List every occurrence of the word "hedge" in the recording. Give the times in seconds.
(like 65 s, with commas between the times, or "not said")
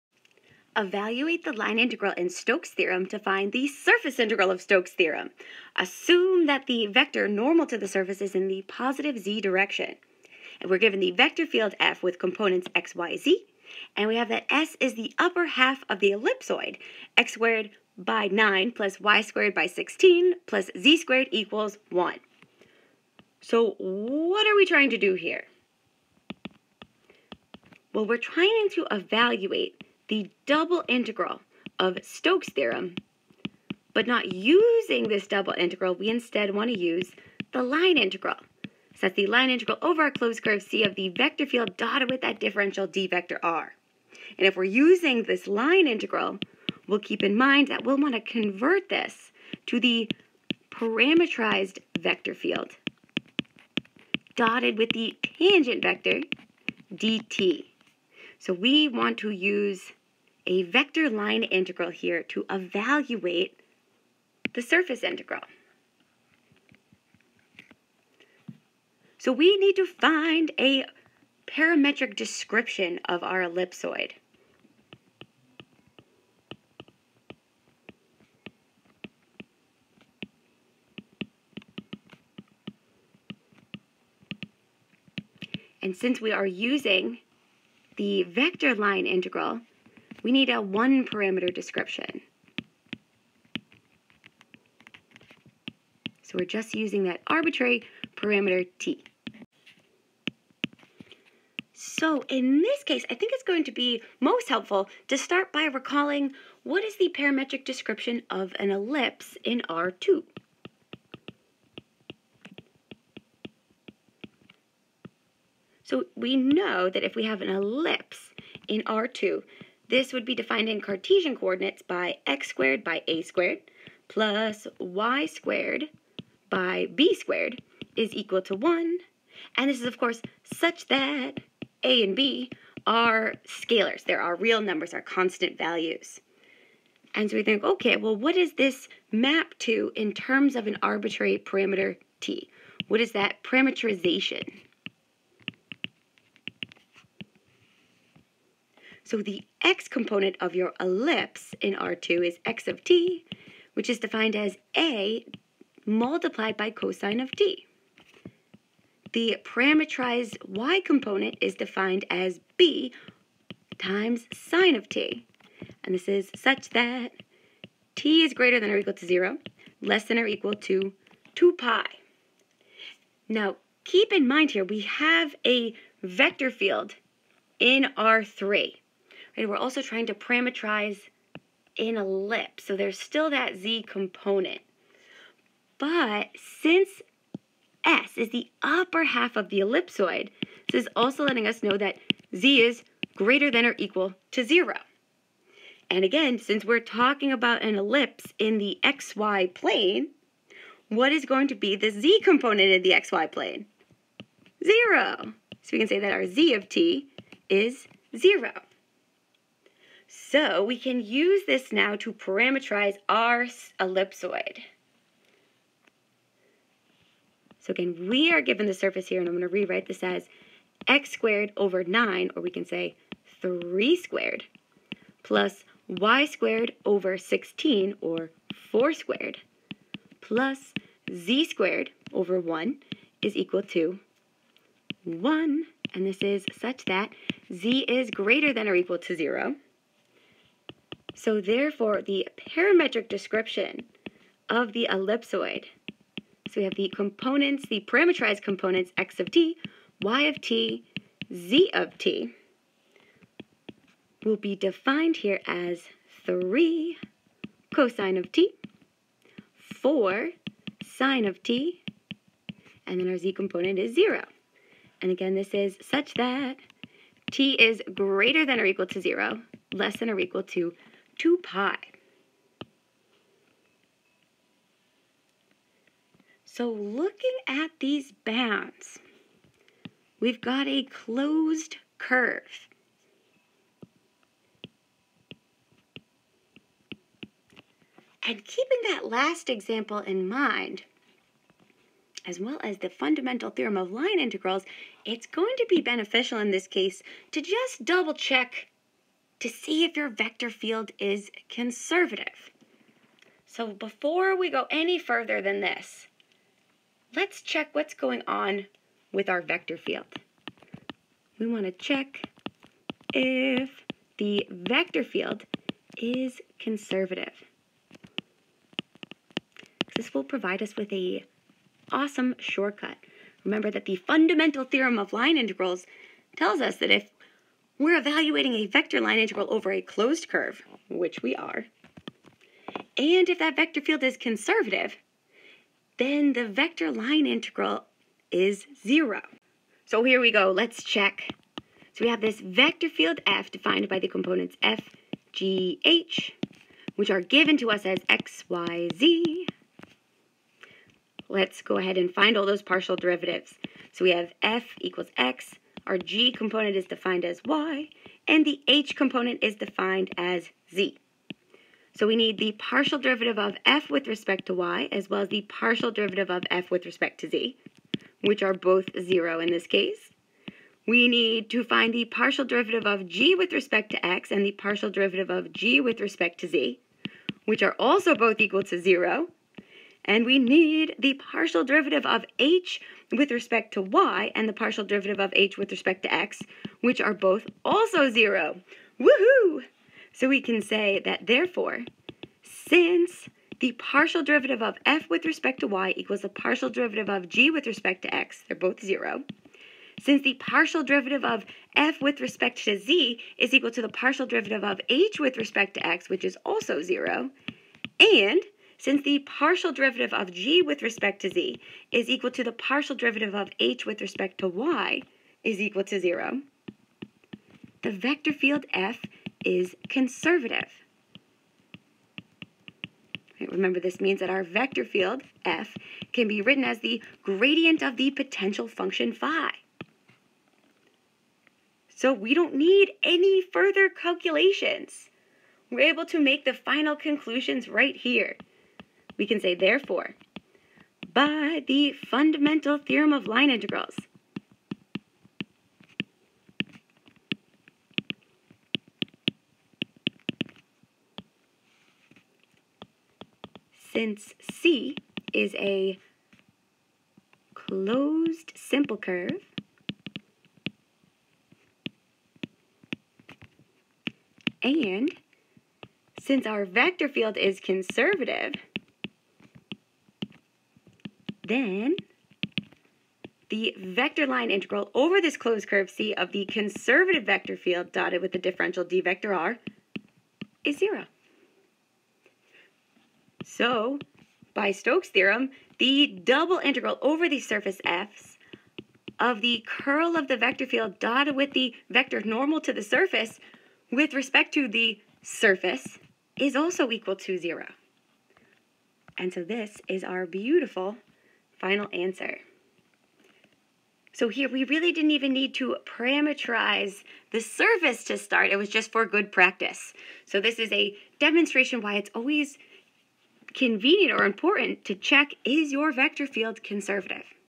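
not said.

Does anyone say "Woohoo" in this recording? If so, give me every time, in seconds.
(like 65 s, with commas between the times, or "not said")
388 s.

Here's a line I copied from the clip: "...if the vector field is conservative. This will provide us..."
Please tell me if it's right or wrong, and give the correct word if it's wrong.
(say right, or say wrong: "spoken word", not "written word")
right.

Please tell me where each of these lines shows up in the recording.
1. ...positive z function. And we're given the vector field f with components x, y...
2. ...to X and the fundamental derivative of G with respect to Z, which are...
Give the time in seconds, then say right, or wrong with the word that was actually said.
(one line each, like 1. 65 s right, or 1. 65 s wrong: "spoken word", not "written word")
1. 8 s wrong: "direction", not "function"
2. 373 s wrong: "partial", not "fundamental".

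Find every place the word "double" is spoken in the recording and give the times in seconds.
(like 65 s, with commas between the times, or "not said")
30 s, 35 s, 297 s, 486 s.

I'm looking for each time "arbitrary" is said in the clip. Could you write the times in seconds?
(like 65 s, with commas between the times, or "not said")
97 s, 140 s.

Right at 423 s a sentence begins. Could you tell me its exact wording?
Remember, this means that our vector field, f, can be written as the gradient of the potential function phi.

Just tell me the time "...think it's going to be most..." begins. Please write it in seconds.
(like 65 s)
103 s.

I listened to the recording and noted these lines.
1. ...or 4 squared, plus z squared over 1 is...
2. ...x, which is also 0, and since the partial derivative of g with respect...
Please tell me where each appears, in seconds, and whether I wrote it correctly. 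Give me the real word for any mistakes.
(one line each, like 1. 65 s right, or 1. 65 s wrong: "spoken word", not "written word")
1. 228 s right
2. 405 s right.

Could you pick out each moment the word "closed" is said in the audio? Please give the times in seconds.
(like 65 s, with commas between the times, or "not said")
40 s, 280 s, 329 s, 457 s, 475 s.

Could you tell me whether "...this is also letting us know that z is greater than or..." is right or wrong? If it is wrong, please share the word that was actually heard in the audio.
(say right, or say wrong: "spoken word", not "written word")
right.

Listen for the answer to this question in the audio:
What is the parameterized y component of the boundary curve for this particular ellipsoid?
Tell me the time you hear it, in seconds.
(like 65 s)
259 s.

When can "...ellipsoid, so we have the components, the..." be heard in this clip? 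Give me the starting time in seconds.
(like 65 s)
244 s.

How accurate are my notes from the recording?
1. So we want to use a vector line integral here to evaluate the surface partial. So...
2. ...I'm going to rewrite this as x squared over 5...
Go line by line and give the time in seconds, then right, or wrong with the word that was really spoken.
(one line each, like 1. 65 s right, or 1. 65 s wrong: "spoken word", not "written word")
1. 58 s wrong: "integral", not "partial"
2. 219 s wrong: "9", not "5".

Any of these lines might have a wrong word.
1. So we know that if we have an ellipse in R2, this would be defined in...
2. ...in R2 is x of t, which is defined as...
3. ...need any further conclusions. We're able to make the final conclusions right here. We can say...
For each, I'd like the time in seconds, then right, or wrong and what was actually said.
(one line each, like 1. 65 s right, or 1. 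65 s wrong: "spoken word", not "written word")
1. 115 s right
2. 151 s right
3. 432 s wrong: "calculations", not "conclusions".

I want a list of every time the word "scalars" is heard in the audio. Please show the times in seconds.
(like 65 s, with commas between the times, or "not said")
133 s.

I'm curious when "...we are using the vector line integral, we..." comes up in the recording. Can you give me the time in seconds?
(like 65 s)
86 s.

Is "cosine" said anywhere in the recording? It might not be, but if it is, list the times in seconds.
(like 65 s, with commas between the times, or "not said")
156 s, 257 s.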